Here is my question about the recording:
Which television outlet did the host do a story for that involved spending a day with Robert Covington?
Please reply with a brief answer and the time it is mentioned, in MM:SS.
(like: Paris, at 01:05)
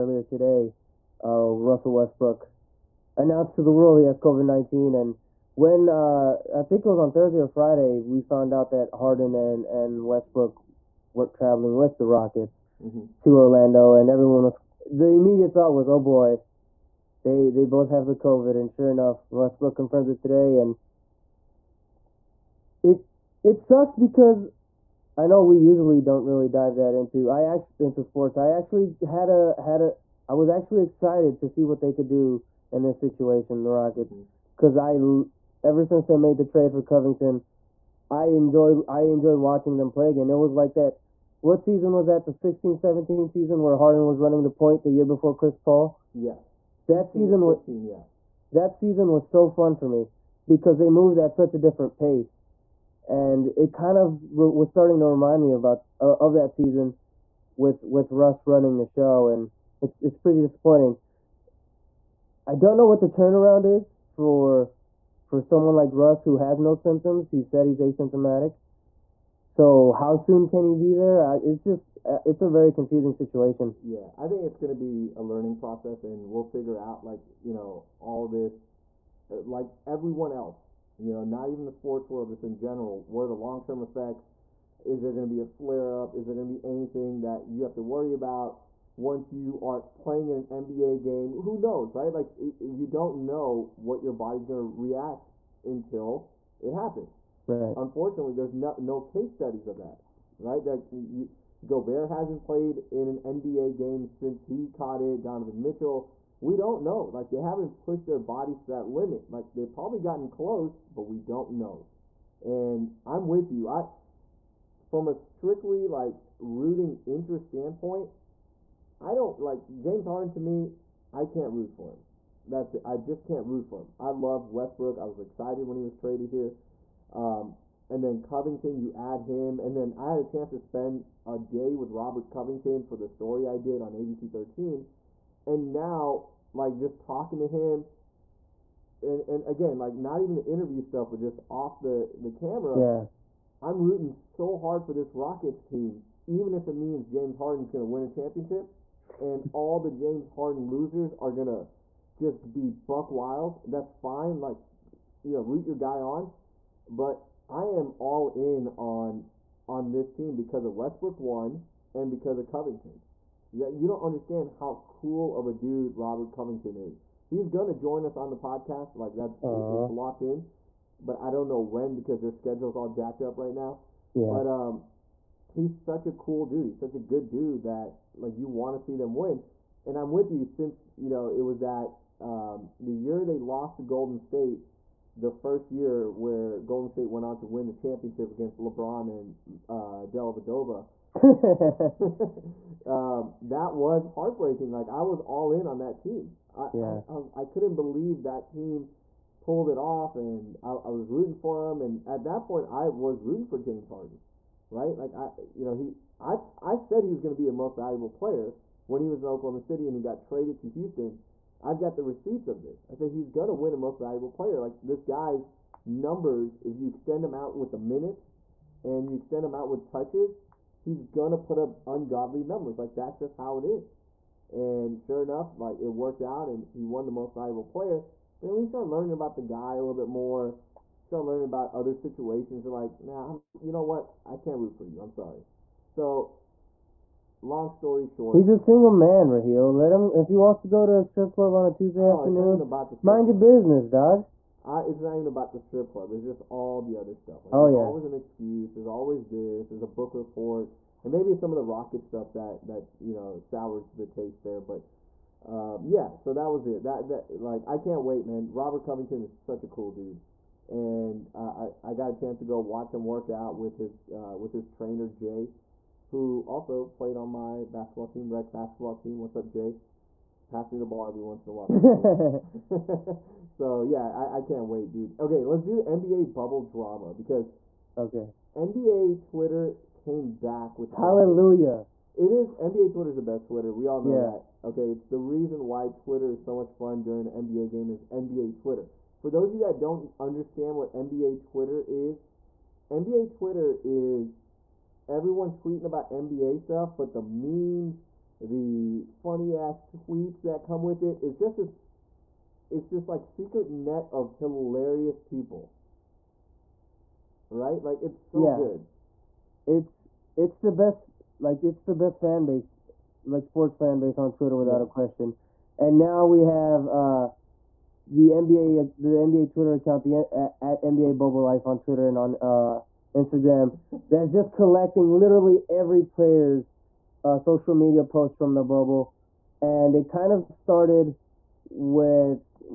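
ABC 13, at 02:13.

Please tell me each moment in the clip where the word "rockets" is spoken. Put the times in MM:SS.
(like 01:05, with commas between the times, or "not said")
00:12, 00:33, 02:25, 04:11.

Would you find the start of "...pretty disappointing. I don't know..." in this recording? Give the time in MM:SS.
01:00.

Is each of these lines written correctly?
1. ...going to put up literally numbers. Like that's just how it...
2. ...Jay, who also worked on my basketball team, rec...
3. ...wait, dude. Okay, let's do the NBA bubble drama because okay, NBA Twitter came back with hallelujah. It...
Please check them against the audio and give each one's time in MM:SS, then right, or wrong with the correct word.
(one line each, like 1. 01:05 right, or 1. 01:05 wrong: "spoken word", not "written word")
1. 03:41 wrong: "ungodly", not "literally"
2. 04:25 wrong: "played", not "worked"
3. 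04:34 right.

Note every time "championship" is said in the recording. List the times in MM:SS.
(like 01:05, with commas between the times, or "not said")
02:28, 03:07.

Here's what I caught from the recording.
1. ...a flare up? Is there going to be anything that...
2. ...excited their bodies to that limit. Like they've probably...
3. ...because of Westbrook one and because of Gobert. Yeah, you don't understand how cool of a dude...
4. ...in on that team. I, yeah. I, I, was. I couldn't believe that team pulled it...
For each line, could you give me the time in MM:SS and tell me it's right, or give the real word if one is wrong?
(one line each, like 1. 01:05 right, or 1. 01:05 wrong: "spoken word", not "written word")
1. 01:25 right
2. 01:47 wrong: "pushed", not "excited"
3. 02:40 wrong: "Covington", not "Gobert"
4. 03:15 right.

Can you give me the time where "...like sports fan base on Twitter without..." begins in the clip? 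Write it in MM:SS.
05:13.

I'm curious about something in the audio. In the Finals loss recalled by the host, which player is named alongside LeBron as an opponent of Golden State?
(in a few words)
Dellavedova.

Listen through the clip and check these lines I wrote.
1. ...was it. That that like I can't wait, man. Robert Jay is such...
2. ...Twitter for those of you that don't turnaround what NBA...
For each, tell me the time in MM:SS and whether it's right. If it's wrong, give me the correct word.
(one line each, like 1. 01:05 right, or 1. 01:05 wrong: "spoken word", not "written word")
1. 04:16 wrong: "Covington", not "Jay"
2. 04:48 wrong: "understand", not "turnaround".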